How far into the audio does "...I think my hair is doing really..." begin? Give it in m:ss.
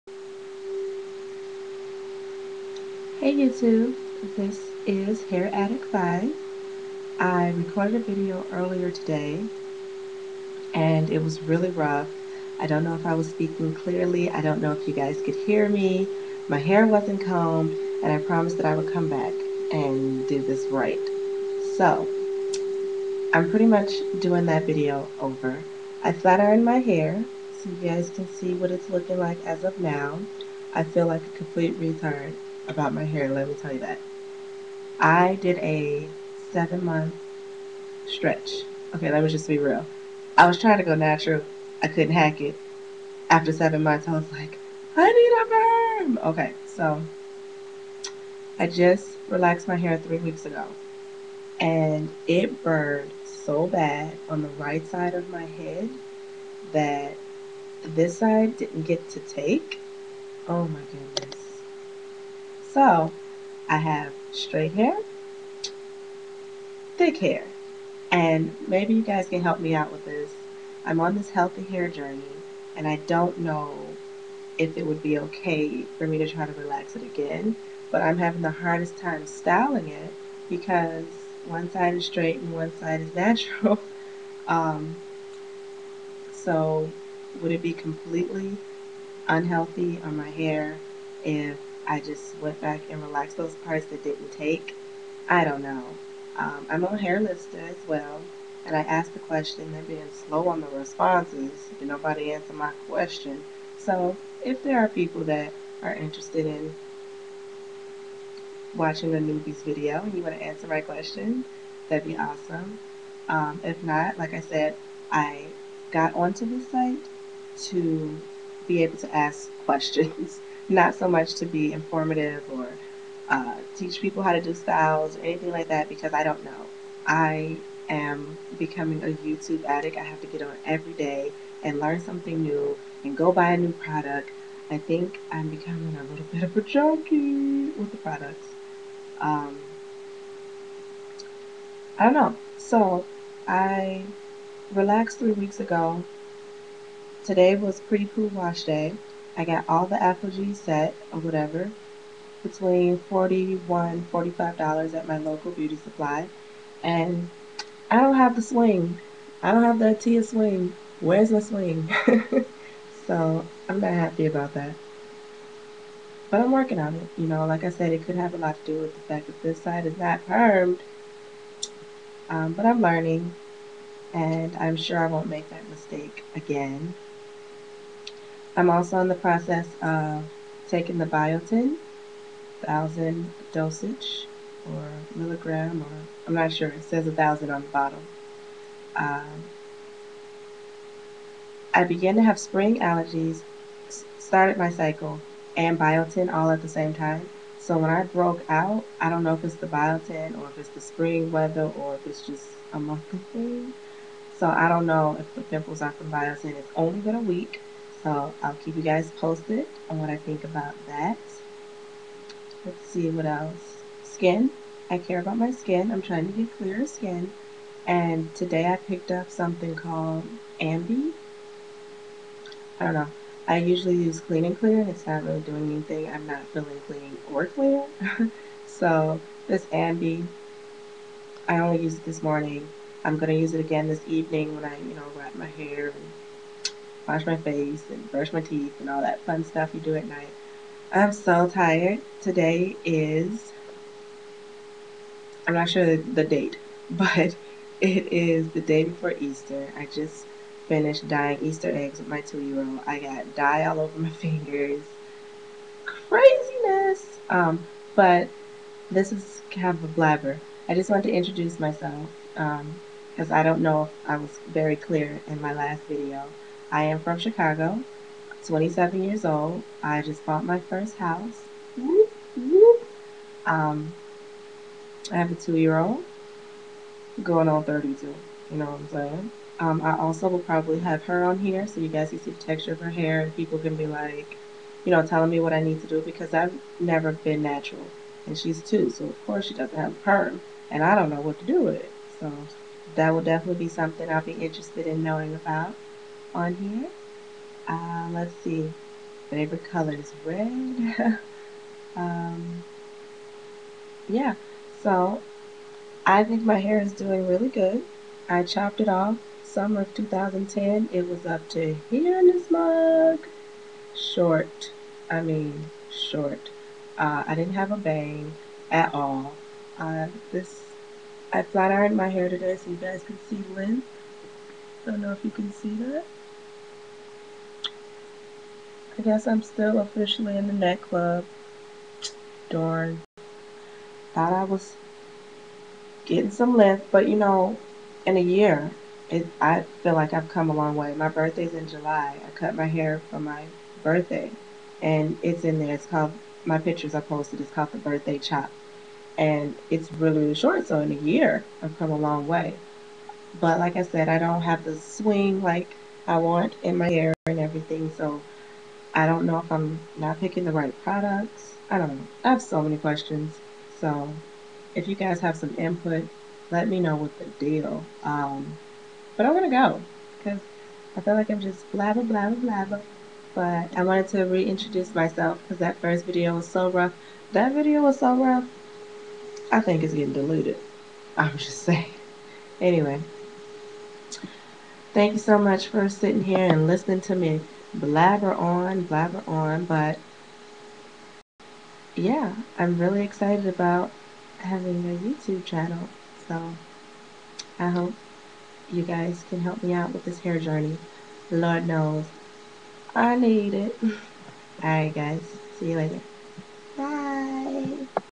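5:06.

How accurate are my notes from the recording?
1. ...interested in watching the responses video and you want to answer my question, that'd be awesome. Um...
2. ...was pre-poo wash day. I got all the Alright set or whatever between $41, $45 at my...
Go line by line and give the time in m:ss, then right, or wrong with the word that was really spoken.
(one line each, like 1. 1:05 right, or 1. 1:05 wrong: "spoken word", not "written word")
1. 1:45 wrong: "newbies", not "responses"
2. 2:27 wrong: "ApHogee", not "Alright".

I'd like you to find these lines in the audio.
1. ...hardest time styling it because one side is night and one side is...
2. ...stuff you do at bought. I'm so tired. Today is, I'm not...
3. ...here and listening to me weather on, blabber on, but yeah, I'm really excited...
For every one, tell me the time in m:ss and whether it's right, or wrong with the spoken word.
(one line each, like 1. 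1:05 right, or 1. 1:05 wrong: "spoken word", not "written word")
1. 1:18 wrong: "straight", not "night"
2. 3:59 wrong: "night", not "bought"
3. 6:26 wrong: "blabber", not "weather".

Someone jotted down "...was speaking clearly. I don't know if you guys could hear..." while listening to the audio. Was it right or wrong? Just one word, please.
right.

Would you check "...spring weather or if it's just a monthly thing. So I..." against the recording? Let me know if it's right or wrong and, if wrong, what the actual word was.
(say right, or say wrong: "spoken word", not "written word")
right.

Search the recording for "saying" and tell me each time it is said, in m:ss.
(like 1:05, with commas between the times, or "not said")
4:38, 6:21.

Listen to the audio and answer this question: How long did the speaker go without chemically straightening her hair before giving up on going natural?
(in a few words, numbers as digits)
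7 months.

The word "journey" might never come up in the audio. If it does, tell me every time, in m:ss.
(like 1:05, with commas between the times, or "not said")
1:11, 6:40.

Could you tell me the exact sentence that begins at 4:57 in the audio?
Uh, let's see, favorite color is red.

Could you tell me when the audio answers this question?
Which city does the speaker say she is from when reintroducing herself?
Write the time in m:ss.
4:27.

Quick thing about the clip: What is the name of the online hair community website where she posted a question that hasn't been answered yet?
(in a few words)
Hair List.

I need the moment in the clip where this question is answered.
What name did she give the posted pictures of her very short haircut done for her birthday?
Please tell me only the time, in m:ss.
5:47.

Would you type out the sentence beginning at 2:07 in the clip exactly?
I am becoming a YouTube addict.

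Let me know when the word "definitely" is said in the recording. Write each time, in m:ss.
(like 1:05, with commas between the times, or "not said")
4:53.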